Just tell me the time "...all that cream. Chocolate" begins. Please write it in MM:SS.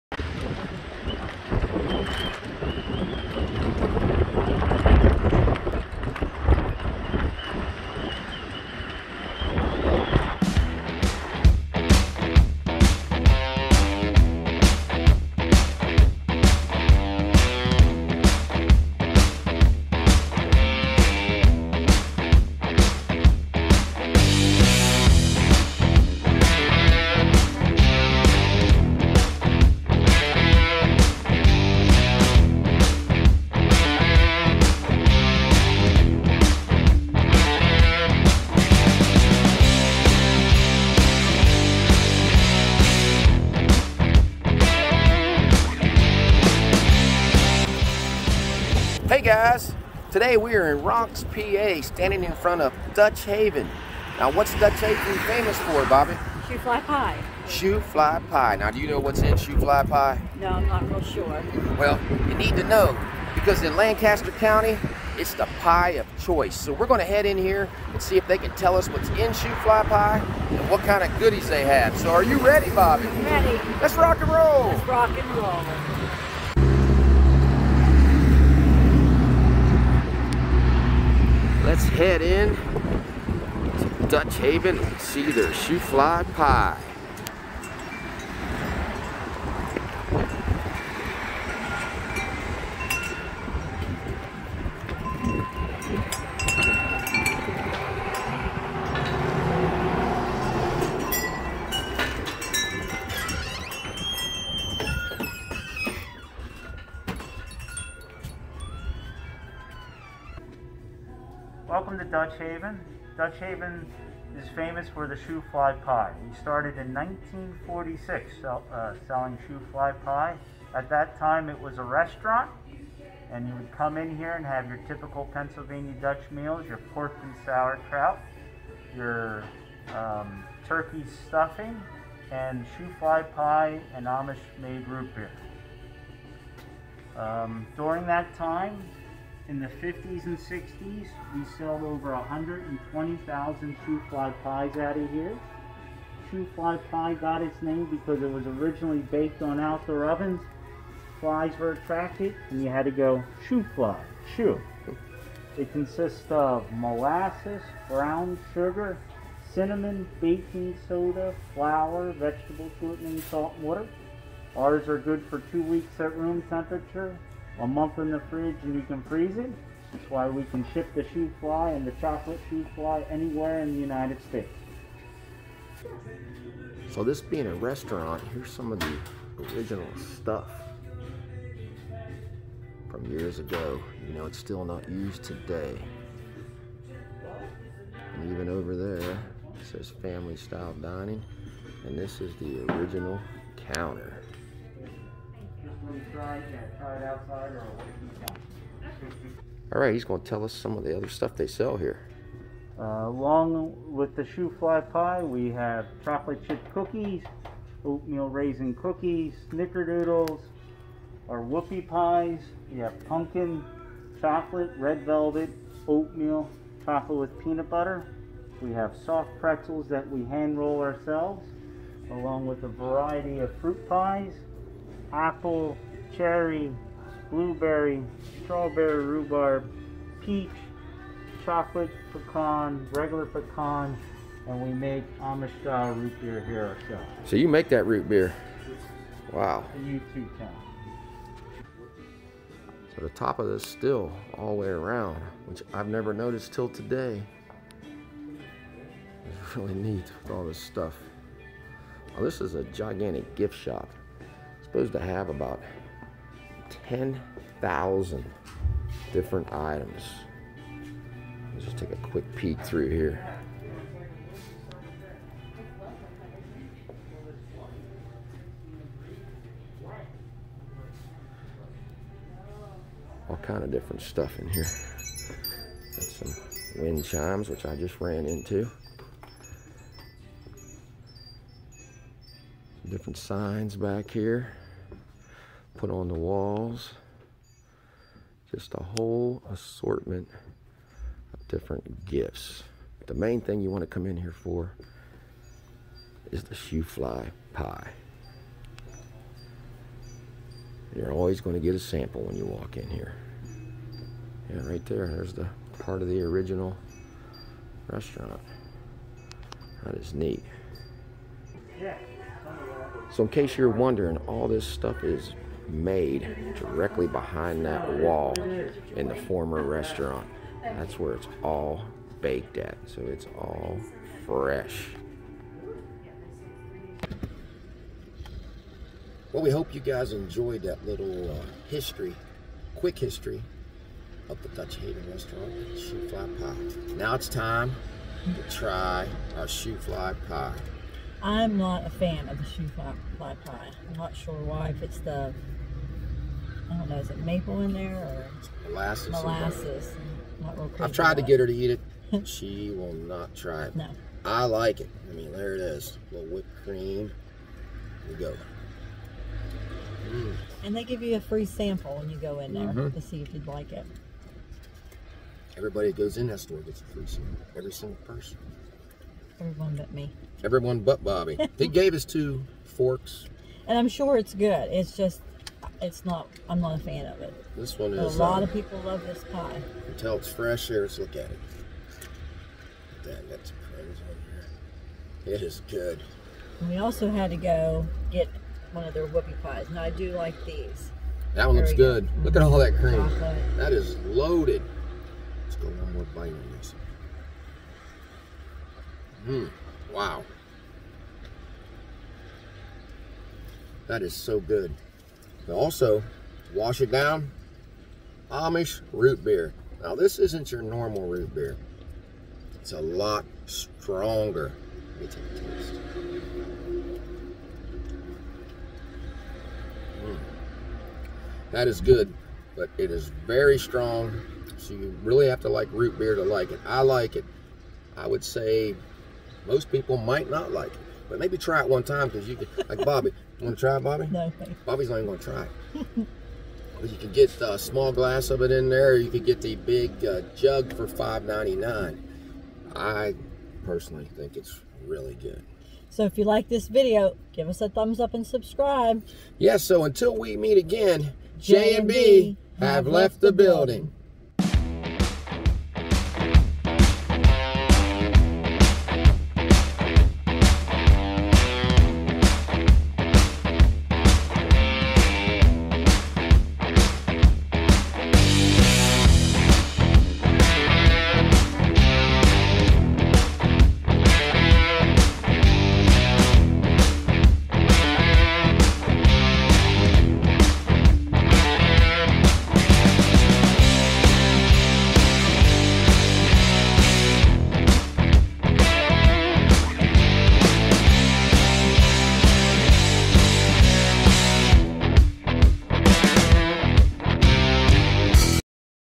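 06:32.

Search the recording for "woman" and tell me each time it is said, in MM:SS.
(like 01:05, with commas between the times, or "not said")
not said.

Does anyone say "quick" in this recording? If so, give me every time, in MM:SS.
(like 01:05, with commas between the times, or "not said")
04:21, 05:32.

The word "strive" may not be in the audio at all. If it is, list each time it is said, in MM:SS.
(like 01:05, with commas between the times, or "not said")
not said.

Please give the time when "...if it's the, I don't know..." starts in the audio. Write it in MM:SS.
05:44.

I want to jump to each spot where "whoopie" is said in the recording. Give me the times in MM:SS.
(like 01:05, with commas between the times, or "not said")
03:31, 06:29.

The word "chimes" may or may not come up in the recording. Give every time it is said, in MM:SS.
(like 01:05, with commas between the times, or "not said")
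04:37.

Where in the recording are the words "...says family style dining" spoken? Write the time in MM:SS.
03:09.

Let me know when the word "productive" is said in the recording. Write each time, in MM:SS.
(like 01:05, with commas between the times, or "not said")
not said.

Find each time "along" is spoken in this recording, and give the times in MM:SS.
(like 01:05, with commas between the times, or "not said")
03:23, 03:42.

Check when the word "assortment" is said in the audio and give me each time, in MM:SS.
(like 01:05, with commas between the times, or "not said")
04:49.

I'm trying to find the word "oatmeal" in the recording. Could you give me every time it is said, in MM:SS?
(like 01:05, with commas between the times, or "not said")
03:27, 03:35.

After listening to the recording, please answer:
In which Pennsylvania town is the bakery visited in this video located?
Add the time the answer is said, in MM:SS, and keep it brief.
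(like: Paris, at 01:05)
Ronks, at 00:50.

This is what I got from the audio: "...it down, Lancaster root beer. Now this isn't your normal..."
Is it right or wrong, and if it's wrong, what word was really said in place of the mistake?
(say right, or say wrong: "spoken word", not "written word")
wrong: "Amish", not "Lancaster".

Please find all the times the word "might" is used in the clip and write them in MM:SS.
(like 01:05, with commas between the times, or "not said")
07:09.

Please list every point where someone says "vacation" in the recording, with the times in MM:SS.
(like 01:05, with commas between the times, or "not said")
not said.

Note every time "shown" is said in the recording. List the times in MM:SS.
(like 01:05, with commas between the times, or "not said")
not said.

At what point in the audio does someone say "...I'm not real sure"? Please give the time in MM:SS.
01:00.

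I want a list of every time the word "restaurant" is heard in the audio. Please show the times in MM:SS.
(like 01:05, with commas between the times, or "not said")
02:01, 02:57, 05:07, 05:19, 05:35.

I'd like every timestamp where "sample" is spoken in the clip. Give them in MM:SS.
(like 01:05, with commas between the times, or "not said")
05:01, 06:01, 06:07.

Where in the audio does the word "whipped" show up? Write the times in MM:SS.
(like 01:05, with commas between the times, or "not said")
05:56.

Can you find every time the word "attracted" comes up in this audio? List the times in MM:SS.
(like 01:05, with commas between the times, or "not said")
02:31.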